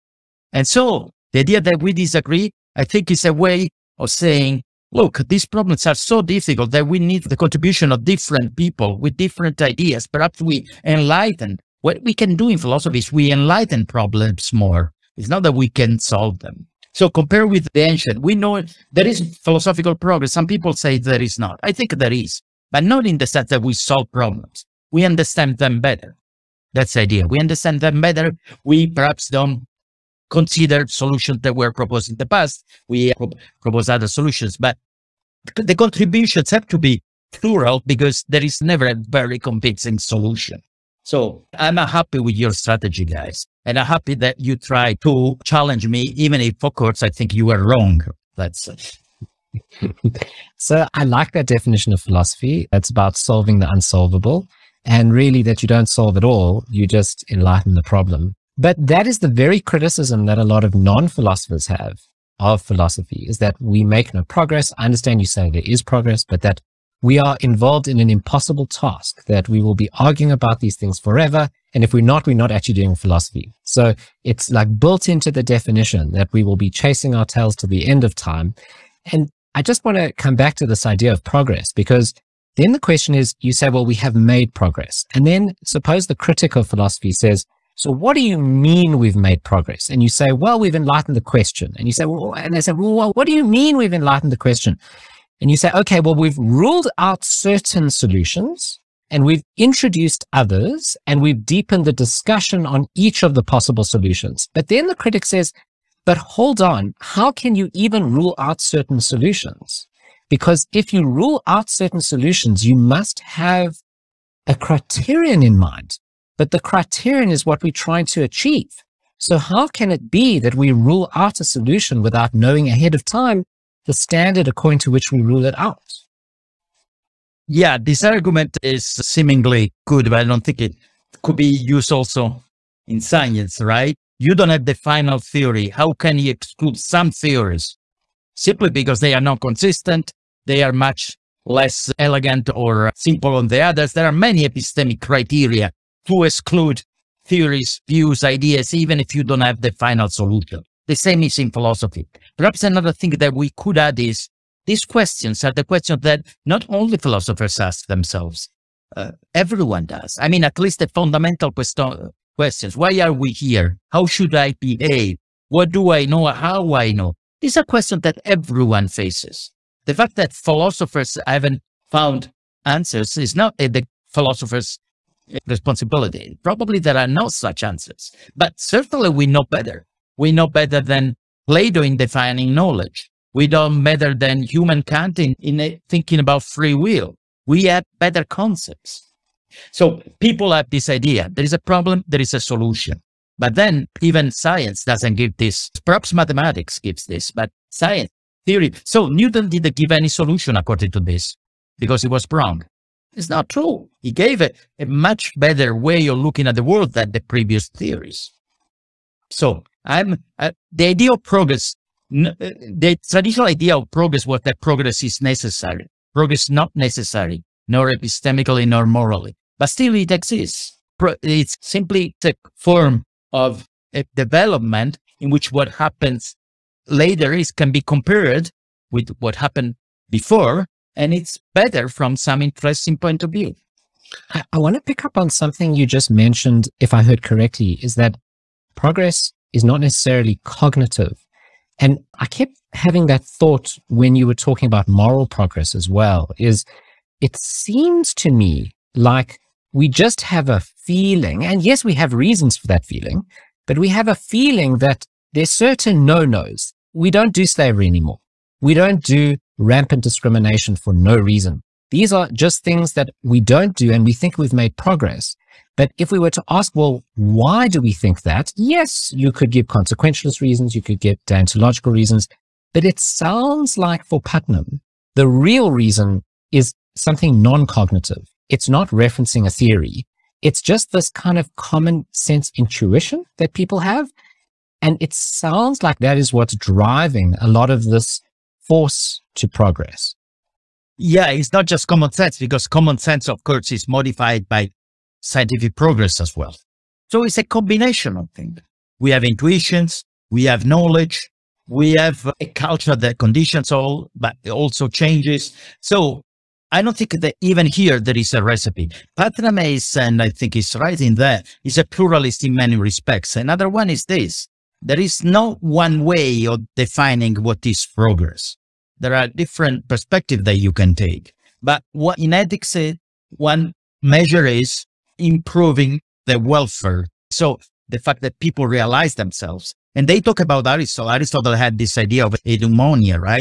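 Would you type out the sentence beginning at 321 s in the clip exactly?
But what in ethics, one measure is improving the welfare.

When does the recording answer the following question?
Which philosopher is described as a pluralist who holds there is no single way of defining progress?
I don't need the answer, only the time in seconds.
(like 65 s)
274 s.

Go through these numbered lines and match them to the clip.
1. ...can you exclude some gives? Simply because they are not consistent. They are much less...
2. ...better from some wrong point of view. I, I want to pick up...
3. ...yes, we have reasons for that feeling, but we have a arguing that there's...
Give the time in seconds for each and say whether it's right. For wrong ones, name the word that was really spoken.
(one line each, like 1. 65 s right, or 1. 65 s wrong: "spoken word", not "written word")
1. 135 s wrong: "theories", not "gives"
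2. 231 s wrong: "interesting", not "wrong"
3. 251 s wrong: "feeling", not "arguing".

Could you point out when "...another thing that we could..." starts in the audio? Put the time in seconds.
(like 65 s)
152 s.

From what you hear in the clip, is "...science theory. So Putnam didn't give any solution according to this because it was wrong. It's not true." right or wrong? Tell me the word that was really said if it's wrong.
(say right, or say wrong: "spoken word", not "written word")
wrong: "Newton", not "Putnam".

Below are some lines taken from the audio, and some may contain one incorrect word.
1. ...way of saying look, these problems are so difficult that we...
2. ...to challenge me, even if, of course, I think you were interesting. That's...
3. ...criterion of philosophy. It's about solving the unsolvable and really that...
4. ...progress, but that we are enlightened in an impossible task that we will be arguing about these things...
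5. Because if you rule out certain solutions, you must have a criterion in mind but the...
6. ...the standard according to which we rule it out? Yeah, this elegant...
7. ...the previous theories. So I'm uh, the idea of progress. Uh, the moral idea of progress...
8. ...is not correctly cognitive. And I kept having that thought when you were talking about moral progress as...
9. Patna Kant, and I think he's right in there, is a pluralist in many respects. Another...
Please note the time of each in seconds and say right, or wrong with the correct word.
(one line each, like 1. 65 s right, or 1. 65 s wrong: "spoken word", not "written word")
1. 3 s right
2. 45 s wrong: "wrong", not "interesting"
3. 51 s wrong: "definition", not "criterion"
4. 65 s wrong: "involved", not "enlightened"
5. 110 s right
6. 123 s wrong: "argument", not "elegant"
7. 207 s wrong: "traditional", not "moral"
8. 239 s wrong: "necessarily", not "correctly"
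9. 309 s wrong: "Mace", not "Kant".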